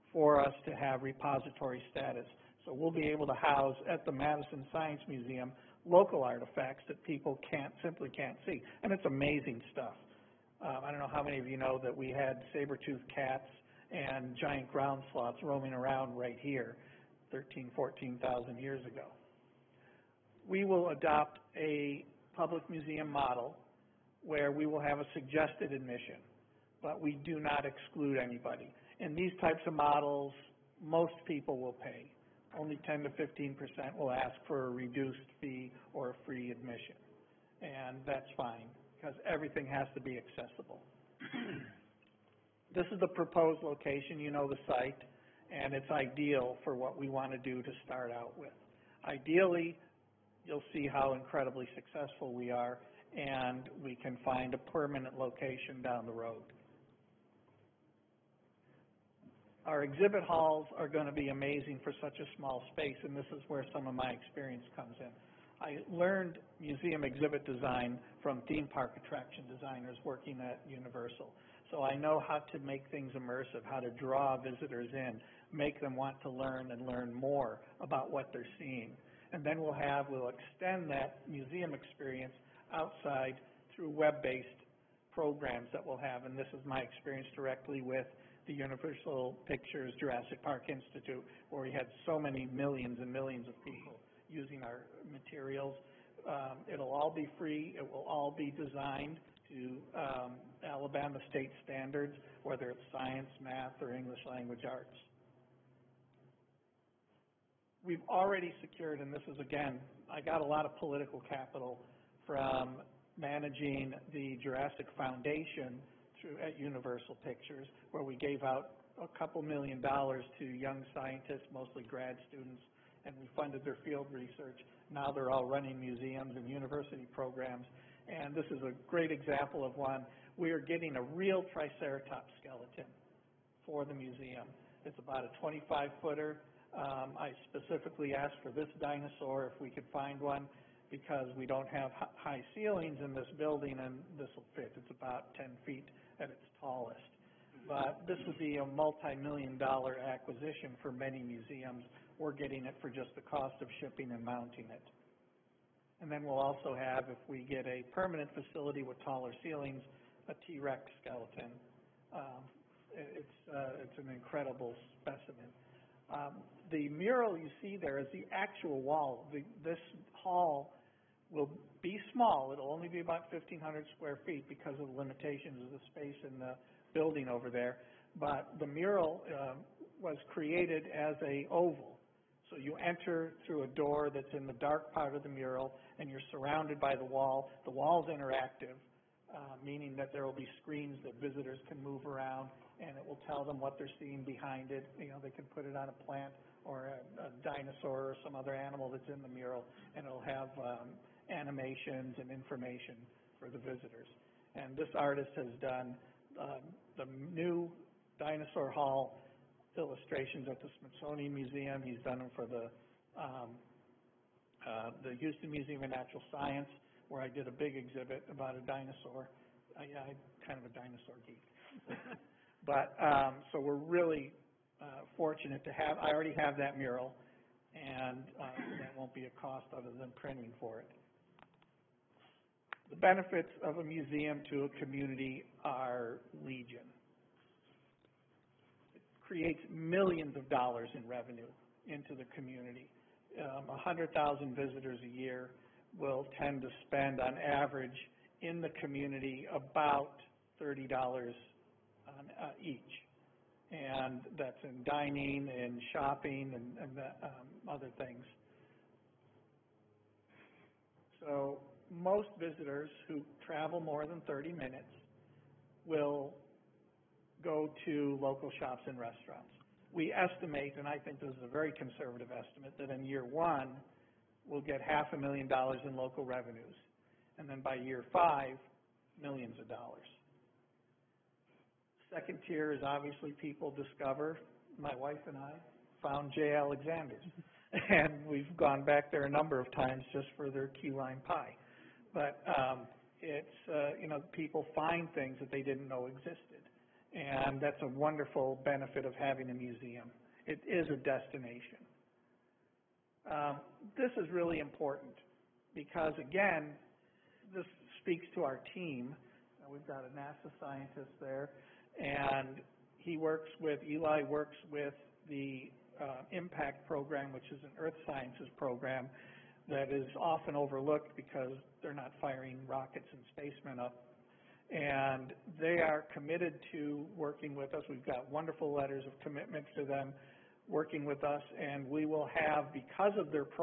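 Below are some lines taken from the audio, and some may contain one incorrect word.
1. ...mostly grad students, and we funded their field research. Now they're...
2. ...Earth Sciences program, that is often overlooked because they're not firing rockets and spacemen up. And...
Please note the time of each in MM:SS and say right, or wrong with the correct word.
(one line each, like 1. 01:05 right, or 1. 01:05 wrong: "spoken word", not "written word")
1. 02:01 right
2. 05:17 right.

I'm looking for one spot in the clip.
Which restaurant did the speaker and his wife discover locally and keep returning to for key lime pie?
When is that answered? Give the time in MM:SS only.
04:46.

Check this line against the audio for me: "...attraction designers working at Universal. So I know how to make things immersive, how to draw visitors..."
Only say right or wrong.
right.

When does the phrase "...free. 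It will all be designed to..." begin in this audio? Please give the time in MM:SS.
01:37.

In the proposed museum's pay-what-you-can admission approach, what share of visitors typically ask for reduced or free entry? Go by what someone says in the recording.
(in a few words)
10 to 15%.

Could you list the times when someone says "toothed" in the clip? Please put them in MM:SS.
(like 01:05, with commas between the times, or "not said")
00:12.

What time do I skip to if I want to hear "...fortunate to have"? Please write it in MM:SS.
03:45.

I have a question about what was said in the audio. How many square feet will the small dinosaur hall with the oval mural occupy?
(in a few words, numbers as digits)
1,500.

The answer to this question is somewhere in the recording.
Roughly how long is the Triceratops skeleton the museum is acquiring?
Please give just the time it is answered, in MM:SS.
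02:15.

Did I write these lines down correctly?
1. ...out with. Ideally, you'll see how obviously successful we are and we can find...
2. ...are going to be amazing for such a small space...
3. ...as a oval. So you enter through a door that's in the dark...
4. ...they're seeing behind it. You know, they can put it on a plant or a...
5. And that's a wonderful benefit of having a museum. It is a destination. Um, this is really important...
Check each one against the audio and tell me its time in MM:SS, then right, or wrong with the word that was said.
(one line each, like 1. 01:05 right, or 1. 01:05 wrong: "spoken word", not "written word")
1. 00:48 wrong: "incredibly", not "obviously"
2. 01:00 right
3. 03:00 right
4. 03:13 right
5. 04:57 right.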